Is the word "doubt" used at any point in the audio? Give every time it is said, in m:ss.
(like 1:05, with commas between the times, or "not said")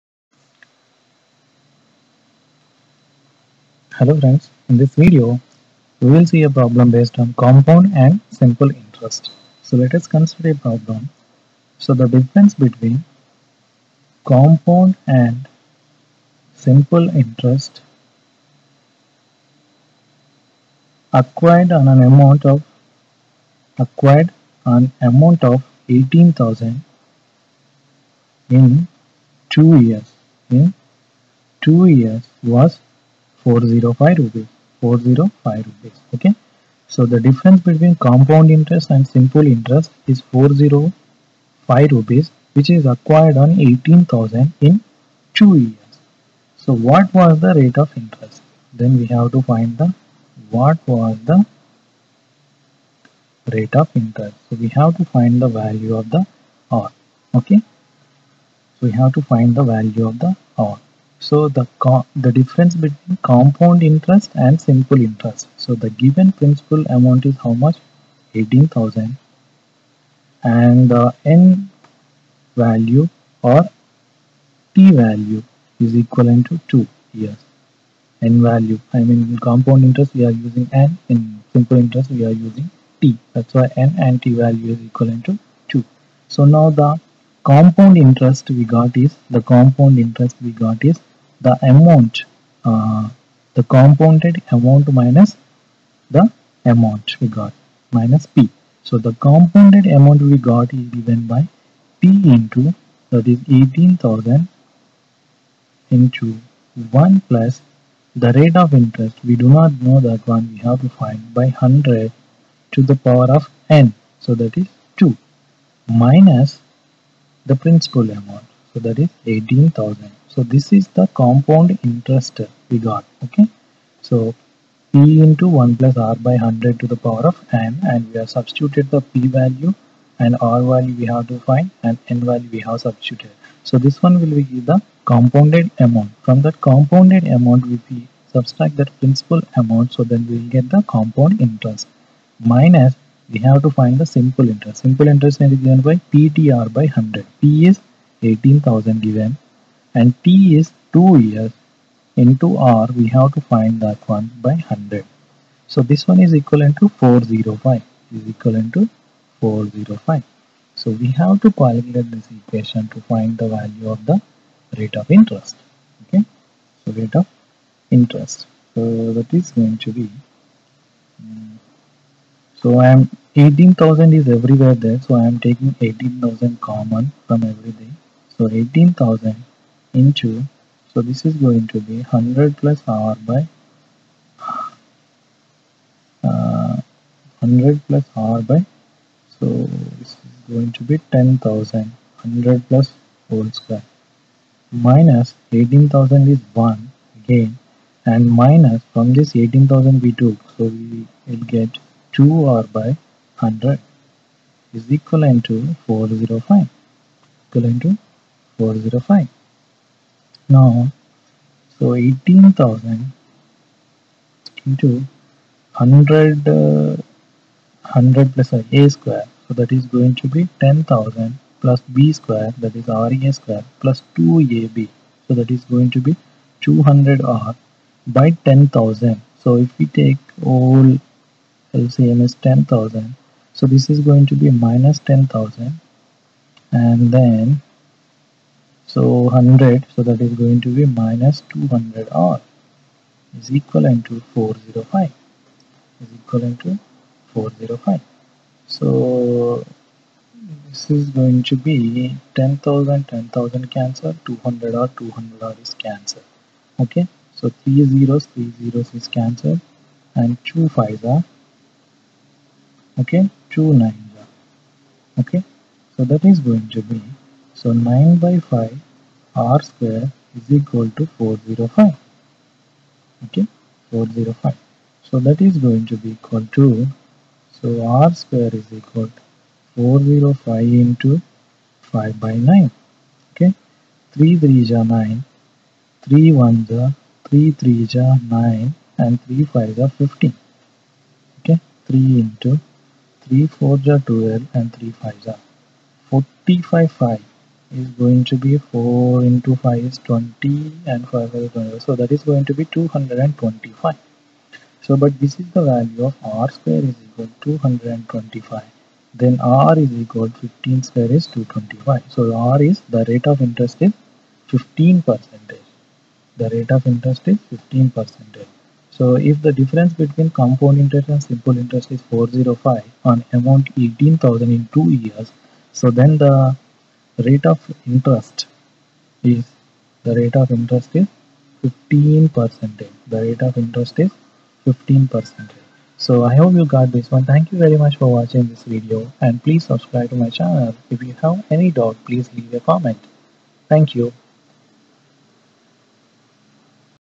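5:41.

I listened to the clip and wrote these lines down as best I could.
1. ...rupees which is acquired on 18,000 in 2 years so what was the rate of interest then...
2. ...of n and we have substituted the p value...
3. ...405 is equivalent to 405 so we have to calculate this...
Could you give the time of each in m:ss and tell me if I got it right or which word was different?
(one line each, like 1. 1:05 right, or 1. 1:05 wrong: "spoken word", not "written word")
1. 0:41 right
2. 2:07 right
3. 2:36 right.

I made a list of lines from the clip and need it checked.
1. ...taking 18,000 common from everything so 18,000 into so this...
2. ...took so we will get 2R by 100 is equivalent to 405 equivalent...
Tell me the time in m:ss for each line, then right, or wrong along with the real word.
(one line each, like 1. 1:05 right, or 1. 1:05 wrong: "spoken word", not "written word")
1. 2:55 right
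2. 3:20 right.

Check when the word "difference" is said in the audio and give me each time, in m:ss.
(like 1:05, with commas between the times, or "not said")
0:12, 0:37, 1:02, 5:19.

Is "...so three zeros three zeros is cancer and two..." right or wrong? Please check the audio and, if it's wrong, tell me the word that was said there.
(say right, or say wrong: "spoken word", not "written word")
right.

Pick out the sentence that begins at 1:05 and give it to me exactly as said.
So the given principal amount is how much?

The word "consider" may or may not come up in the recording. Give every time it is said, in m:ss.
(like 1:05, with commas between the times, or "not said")
0:10.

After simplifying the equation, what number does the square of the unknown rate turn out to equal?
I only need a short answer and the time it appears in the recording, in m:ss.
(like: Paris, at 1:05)
225, at 5:07.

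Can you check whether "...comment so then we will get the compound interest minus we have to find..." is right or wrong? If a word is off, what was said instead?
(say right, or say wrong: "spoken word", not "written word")
wrong: "amount", not "comment".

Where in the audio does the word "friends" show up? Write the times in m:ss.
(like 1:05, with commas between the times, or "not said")
0:04.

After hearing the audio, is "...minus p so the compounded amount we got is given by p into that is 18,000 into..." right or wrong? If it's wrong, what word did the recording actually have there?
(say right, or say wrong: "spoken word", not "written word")
right.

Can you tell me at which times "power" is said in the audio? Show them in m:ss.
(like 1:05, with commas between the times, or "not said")
1:53, 2:07.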